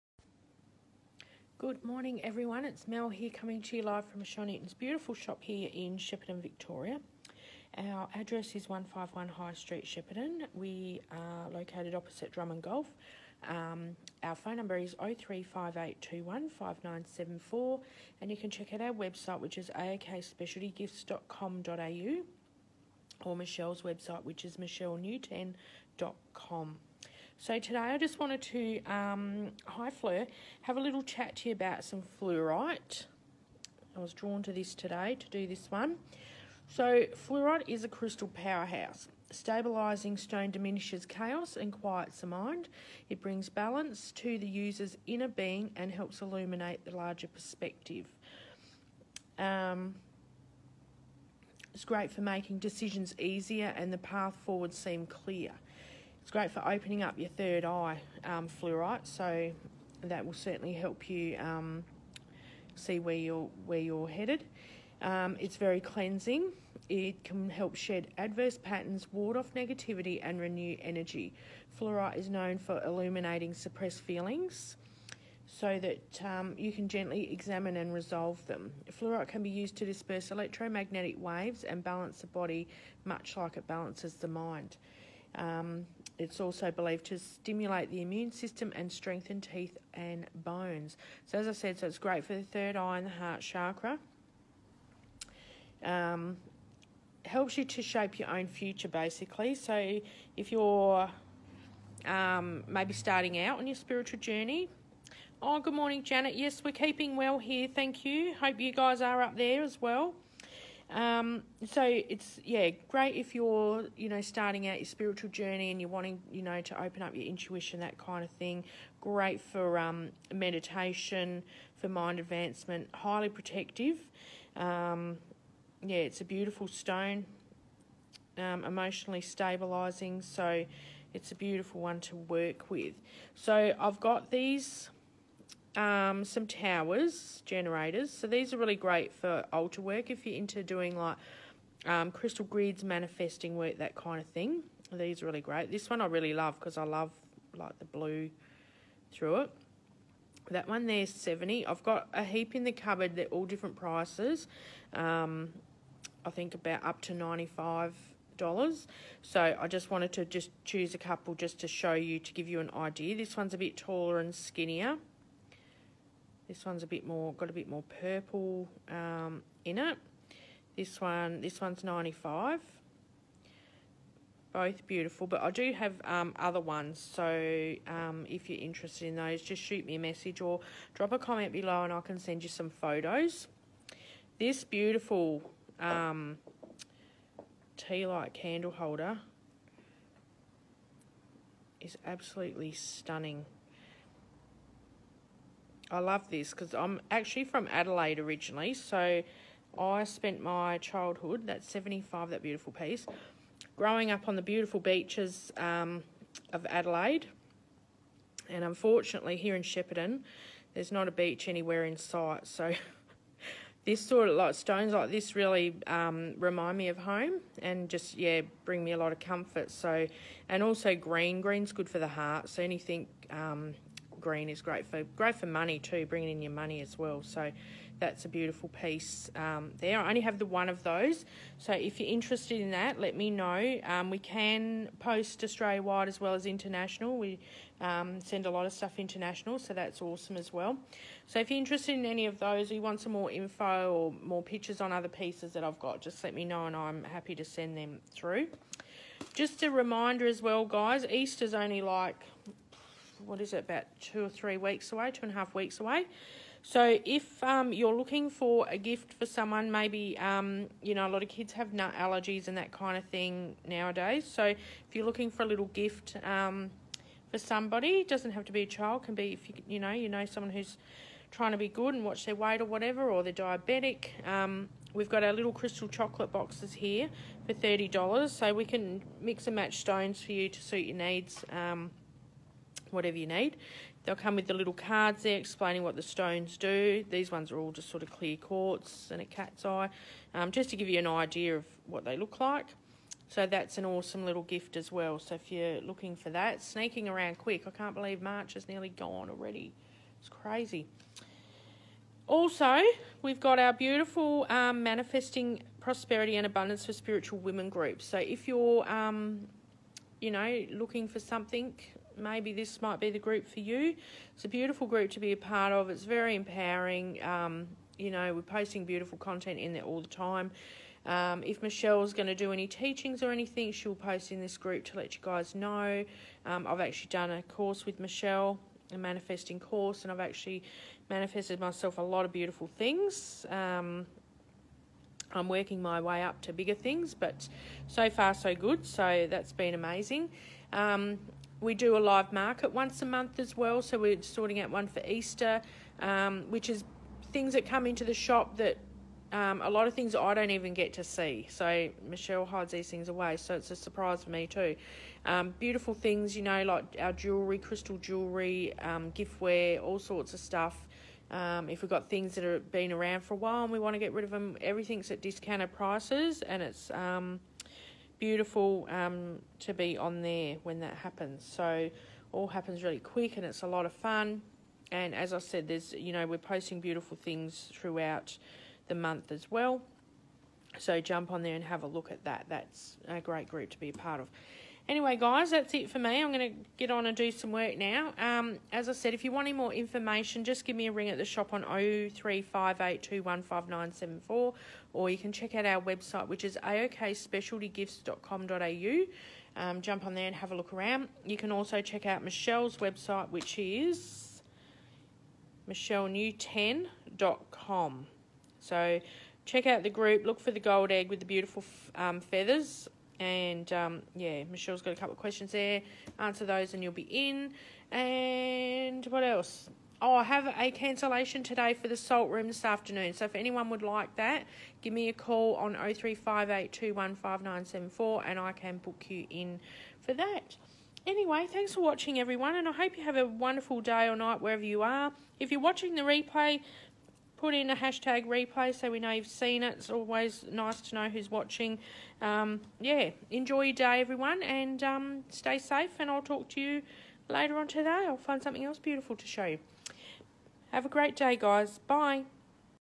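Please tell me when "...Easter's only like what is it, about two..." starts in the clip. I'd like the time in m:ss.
4:11.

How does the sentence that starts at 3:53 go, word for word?
Um, we can post Australia wide as well as international.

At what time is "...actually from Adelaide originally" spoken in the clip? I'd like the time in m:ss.
3:17.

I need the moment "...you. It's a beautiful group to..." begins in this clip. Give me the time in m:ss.
5:13.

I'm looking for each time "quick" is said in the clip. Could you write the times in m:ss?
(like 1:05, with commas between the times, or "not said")
4:57, 6:12.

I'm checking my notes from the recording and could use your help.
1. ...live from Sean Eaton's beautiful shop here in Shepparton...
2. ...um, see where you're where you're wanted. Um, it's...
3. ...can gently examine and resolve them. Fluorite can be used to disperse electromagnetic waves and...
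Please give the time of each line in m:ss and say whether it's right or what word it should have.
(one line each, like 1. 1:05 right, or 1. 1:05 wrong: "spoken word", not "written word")
1. 0:03 right
2. 1:01 wrong: "headed", not "wanted"
3. 1:16 right.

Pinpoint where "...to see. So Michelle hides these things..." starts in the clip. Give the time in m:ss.
5:50.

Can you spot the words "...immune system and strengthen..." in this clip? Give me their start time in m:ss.
1:28.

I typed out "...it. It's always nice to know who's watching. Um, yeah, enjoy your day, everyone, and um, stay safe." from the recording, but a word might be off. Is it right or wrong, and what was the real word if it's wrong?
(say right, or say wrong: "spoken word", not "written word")
right.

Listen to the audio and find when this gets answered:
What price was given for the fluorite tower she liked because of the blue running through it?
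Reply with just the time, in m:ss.
2:31.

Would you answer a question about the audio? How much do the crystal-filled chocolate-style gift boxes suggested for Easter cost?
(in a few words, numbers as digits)
$30.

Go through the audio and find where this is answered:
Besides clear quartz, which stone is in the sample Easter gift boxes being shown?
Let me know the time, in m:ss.
4:49.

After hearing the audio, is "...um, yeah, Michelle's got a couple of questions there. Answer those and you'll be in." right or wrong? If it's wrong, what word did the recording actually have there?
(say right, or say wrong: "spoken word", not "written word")
right.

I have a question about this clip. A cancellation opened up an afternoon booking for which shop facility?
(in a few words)
salt room.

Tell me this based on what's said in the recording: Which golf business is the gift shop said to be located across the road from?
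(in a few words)
Drummond Golf.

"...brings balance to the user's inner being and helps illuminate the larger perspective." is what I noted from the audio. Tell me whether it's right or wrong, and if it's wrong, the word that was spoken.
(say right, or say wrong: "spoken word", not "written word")
right.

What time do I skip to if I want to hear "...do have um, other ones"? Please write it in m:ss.
2:55.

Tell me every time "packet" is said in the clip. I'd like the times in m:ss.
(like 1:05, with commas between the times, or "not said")
not said.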